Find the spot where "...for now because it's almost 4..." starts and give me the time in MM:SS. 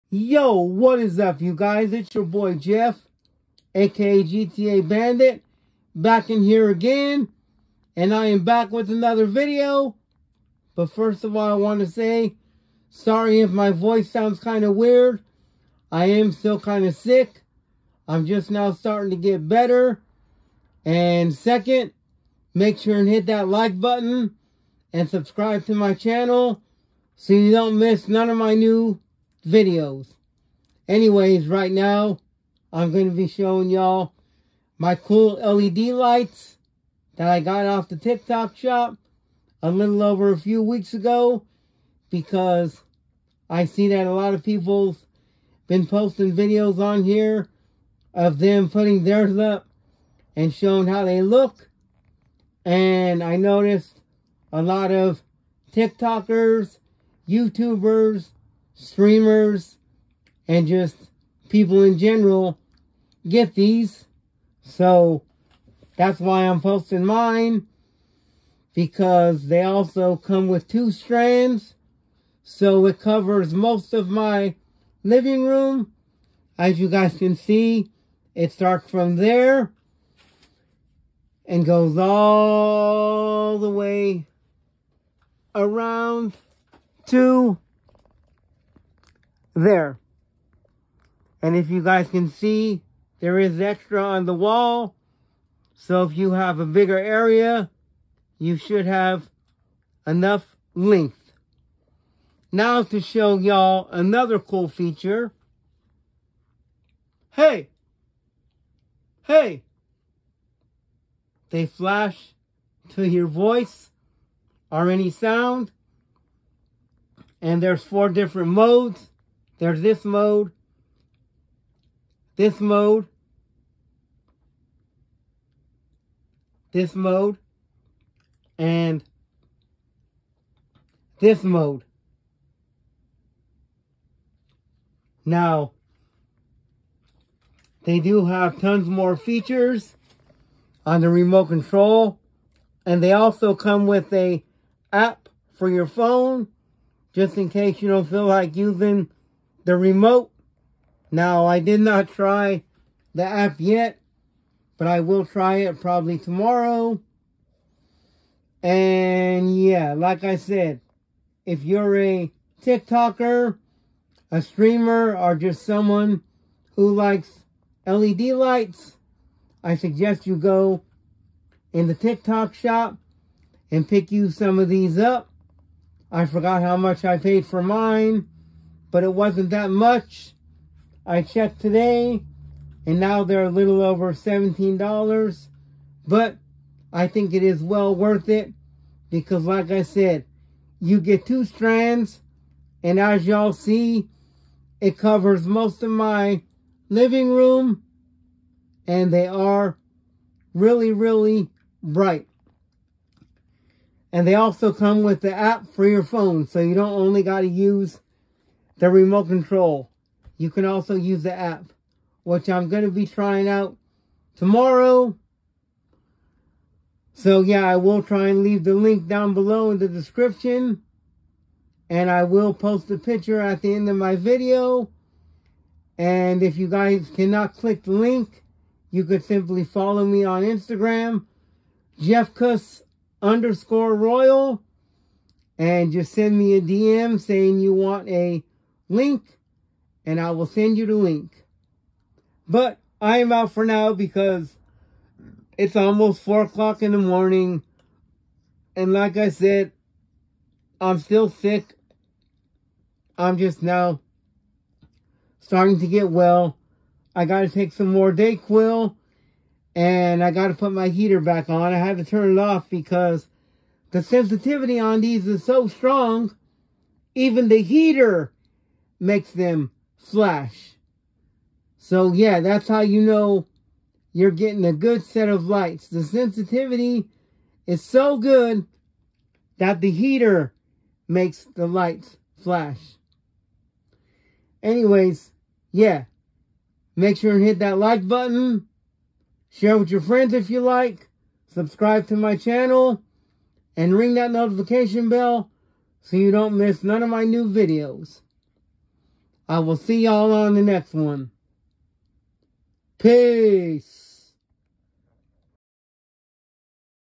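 04:03.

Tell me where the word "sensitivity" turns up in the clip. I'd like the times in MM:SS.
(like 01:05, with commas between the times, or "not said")
04:24, 04:36.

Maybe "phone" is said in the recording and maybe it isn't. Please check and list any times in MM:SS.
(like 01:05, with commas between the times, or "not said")
02:25, 03:26.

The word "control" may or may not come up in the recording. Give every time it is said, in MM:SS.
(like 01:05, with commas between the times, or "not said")
02:21, 03:29.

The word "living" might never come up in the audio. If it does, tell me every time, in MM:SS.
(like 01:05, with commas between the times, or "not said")
01:15, 03:16.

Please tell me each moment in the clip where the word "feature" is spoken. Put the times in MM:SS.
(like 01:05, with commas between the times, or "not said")
01:44, 02:19.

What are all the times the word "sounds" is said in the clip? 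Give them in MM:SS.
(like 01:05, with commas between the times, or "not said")
00:14, 01:55.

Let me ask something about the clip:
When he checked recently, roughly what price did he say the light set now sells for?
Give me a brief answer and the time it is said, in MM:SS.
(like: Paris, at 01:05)
a little over $17, at 03:03.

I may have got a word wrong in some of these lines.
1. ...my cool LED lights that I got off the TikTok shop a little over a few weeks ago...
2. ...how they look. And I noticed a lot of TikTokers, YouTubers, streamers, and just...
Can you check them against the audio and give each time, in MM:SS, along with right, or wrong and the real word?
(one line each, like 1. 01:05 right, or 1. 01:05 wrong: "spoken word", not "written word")
1. 00:34 right
2. 00:50 right.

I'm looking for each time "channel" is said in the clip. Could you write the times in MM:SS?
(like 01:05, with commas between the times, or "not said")
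00:25, 04:52.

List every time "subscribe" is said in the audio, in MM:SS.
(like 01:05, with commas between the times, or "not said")
00:25, 04:51.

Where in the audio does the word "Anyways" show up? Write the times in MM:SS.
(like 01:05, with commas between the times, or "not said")
00:30, 04:44.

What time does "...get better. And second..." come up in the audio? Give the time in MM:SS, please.
00:19.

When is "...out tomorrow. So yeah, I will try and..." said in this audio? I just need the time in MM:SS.
03:33.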